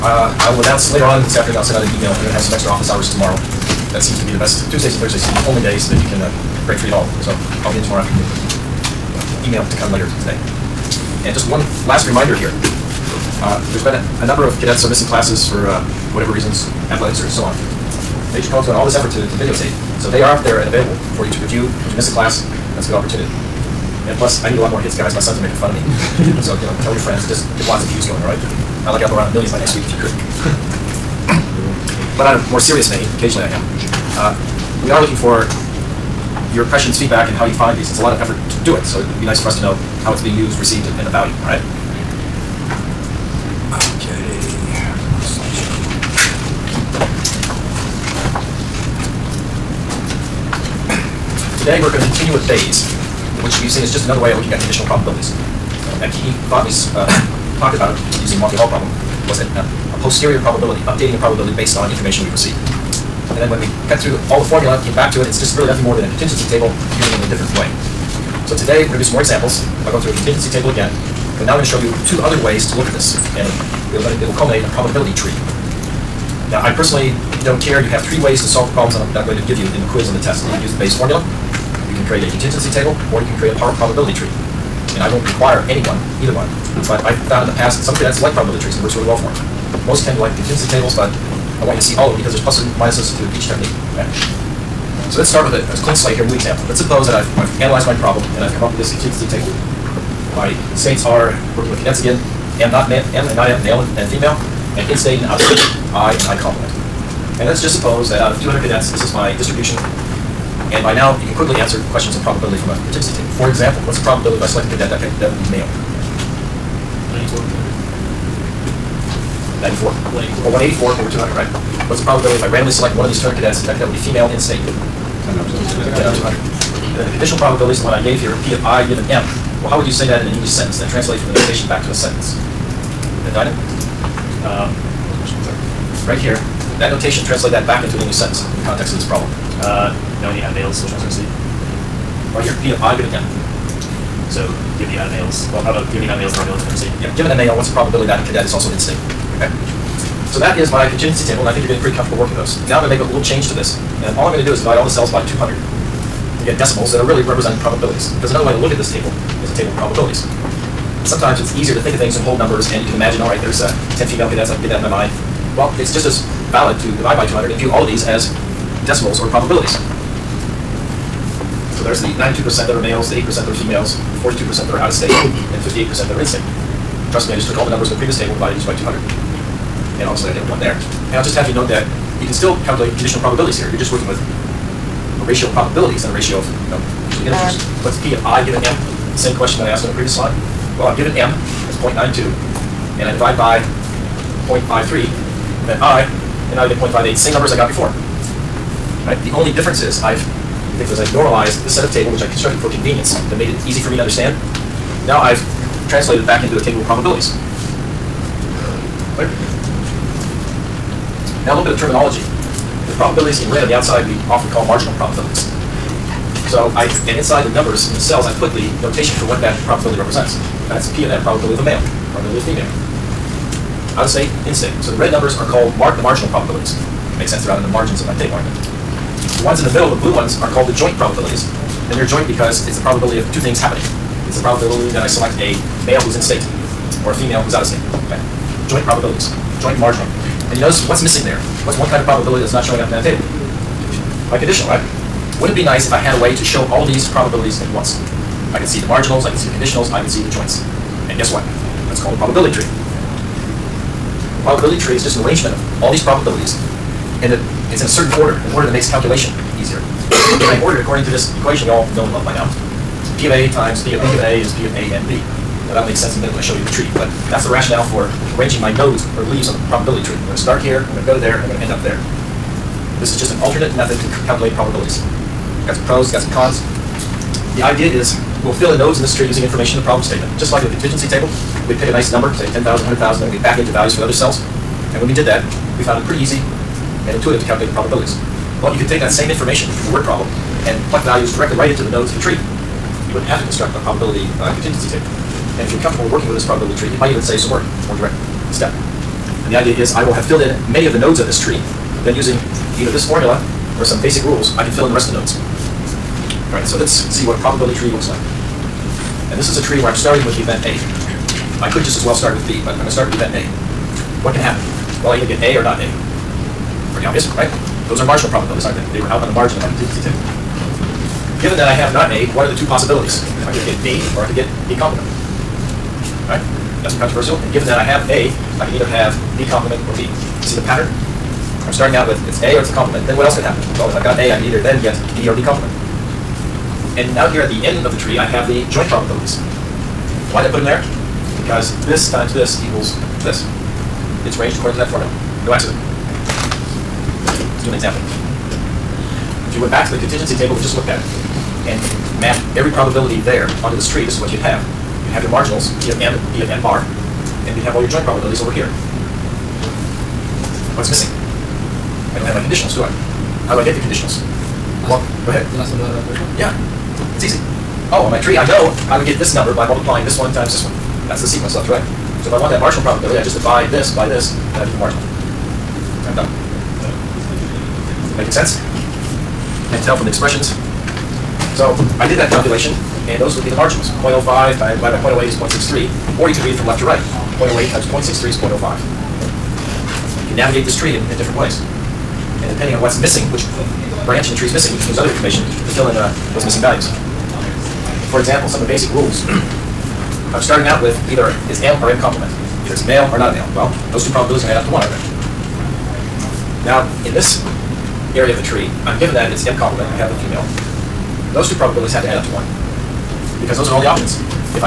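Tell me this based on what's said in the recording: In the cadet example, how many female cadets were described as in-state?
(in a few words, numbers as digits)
10.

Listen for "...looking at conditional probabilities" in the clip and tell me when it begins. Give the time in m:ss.
0:54.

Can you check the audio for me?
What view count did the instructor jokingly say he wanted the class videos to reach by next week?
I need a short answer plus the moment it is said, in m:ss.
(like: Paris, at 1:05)
a million, at 0:29.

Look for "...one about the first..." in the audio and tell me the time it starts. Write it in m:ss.
6:05.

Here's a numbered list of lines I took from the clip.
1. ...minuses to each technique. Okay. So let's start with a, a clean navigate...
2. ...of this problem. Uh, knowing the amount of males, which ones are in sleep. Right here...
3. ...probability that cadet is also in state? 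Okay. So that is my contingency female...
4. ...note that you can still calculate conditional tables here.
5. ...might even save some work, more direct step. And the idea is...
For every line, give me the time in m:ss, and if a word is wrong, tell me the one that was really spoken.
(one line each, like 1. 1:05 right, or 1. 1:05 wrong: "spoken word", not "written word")
1. 1:32 wrong: "slate", not "navigate"
2. 2:18 right
3. 2:27 wrong: "table", not "female"
4. 3:01 wrong: "probabilities", not "tables"
5. 4:56 right.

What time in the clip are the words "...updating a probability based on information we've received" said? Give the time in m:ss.
1:00.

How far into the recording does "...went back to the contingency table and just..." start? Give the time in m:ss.
5:49.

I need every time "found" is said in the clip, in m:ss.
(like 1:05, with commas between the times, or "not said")
1:27, 4:45.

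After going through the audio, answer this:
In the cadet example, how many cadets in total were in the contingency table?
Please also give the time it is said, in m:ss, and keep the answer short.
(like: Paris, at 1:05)
200, at 1:48.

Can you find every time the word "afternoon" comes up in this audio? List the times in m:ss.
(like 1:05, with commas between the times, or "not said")
0:01, 0:08.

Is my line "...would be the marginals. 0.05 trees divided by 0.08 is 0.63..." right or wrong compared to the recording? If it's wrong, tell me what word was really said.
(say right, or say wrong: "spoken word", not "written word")
wrong: "times", not "trees".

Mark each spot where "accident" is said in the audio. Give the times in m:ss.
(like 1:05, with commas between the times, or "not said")
5:45.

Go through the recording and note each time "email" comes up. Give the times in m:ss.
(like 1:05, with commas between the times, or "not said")
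0:01, 0:09.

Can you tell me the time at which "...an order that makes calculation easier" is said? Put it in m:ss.
4:18.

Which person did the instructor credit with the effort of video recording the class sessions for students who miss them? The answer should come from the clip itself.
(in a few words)
Major Cohen.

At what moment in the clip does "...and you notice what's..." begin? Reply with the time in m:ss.
4:00.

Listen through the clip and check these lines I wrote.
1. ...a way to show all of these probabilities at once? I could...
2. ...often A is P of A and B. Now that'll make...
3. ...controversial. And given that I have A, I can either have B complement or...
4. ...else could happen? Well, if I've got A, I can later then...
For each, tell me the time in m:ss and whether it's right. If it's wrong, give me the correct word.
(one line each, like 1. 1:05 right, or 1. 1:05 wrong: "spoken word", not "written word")
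1. 4:06 right
2. 4:24 wrong: "given", not "often"
3. 5:27 right
4. 5:33 wrong: "either", not "later".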